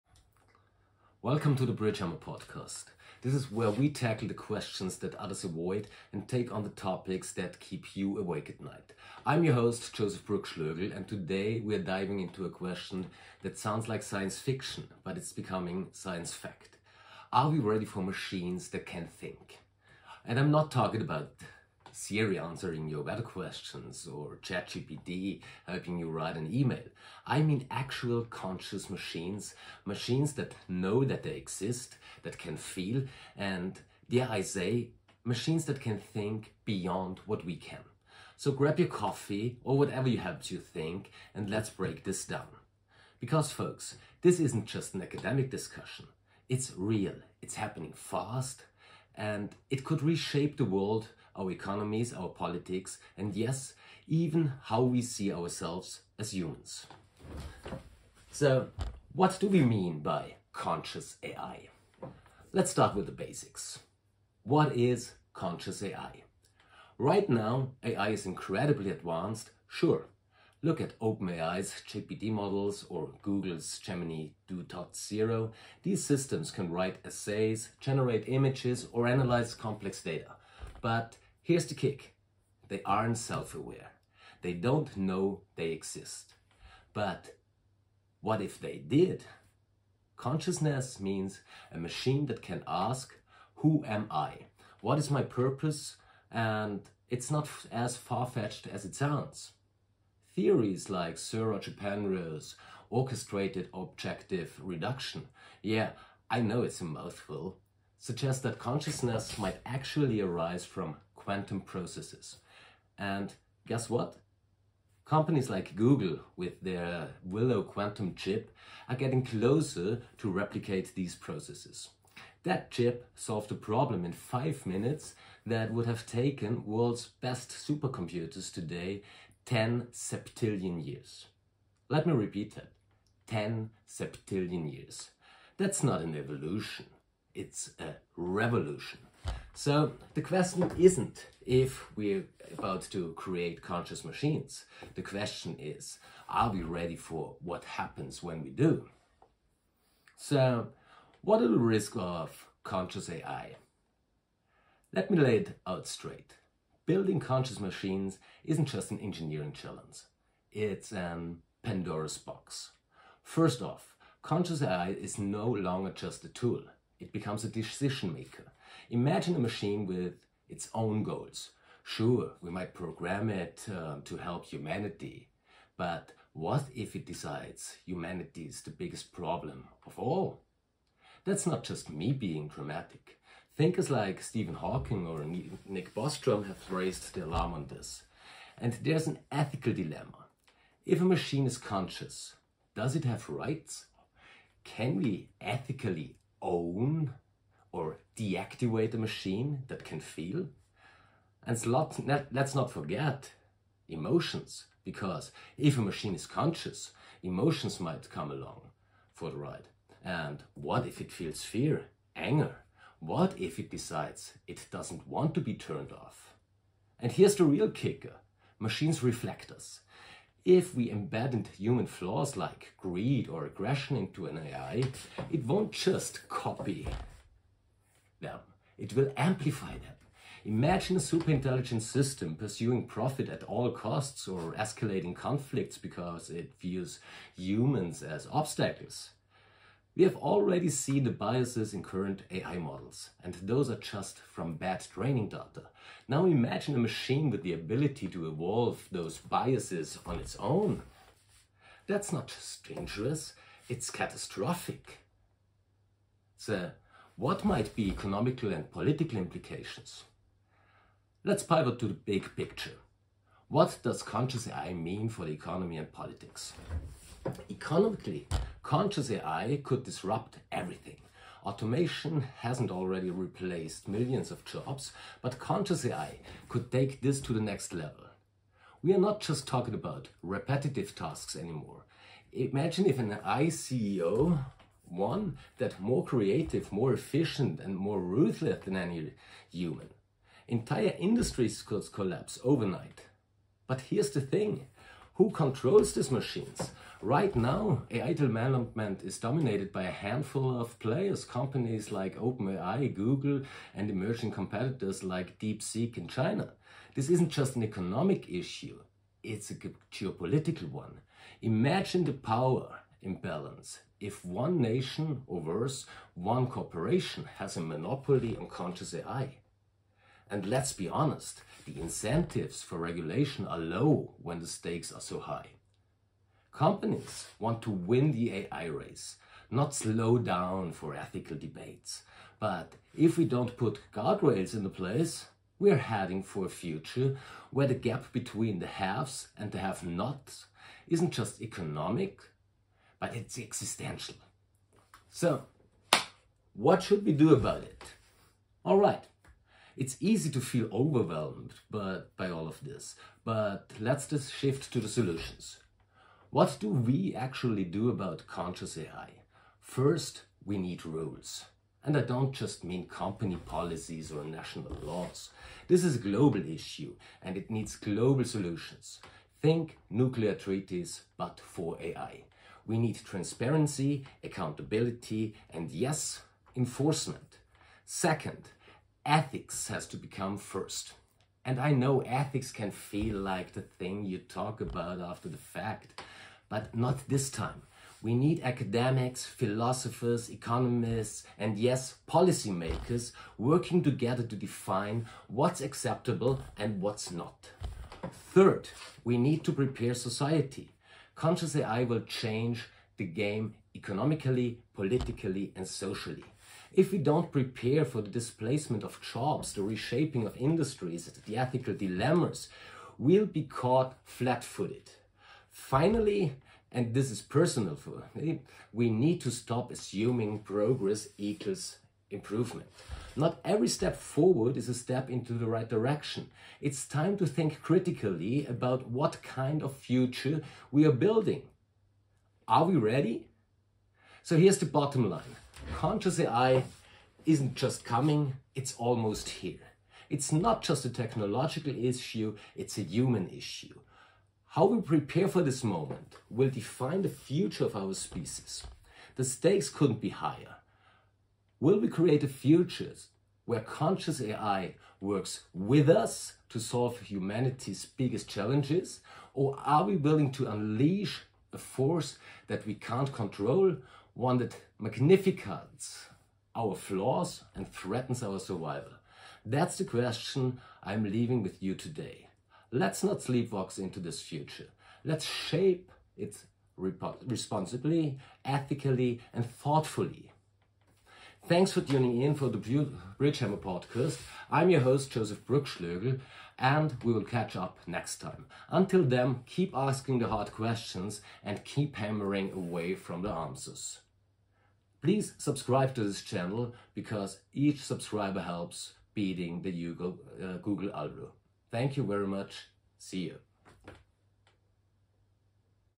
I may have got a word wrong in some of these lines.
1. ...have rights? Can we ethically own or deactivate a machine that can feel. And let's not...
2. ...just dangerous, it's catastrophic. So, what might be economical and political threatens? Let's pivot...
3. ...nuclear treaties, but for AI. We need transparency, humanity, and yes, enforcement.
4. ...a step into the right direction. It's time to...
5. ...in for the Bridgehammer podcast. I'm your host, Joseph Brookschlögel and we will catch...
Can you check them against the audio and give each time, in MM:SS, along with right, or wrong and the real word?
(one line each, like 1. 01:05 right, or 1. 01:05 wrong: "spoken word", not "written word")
1. 03:13 right
2. 04:12 wrong: "implications", not "threatens"
3. 06:09 wrong: "accountability", not "humanity"
4. 07:04 right
5. 08:02 right.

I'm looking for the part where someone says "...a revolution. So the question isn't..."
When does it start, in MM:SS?
02:17.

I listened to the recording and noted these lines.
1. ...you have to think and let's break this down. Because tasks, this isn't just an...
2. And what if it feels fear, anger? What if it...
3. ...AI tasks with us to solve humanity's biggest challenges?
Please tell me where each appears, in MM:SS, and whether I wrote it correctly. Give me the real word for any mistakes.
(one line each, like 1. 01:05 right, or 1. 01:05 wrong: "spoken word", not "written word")
1. 00:40 wrong: "folks", not "tasks"
2. 03:30 right
3. 07:34 wrong: "works", not "tasks".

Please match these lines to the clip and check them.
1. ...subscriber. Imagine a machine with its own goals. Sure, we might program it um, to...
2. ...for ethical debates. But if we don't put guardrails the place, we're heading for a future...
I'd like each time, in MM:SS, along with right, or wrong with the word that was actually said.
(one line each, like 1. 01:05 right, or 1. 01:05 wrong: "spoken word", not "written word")
1. 02:48 wrong: "maker", not "subscriber"
2. 05:30 right.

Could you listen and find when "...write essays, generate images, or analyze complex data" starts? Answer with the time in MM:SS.
01:16.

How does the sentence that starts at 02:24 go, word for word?
The question is, are we ready for what happens when we do?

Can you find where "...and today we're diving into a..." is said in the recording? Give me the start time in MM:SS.
00:10.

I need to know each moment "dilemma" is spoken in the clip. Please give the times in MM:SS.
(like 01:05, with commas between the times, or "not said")
03:09, 06:51.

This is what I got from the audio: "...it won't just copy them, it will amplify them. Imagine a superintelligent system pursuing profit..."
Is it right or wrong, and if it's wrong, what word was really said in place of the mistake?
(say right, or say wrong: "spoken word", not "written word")
right.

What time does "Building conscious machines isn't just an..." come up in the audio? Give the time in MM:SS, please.
02:36.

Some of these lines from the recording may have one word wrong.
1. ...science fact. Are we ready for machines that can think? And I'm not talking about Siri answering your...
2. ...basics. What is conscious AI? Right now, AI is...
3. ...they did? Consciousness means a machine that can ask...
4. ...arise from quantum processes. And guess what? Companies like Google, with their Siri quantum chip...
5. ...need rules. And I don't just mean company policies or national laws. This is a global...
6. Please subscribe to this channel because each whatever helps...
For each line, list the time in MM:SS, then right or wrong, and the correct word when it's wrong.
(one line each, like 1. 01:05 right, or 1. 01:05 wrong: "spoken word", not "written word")
1. 00:15 right
2. 01:03 right
3. 01:28 right
4. 01:50 wrong: "Willow", not "Siri"
5. 06:00 right
6. 08:15 wrong: "subscriber", not "whatever".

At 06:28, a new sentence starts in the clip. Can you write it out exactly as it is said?
We need academics, philosophers, economists, and yes, policymakers working together to define what's acceptable and what's not.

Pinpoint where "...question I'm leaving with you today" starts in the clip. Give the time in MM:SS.
07:49.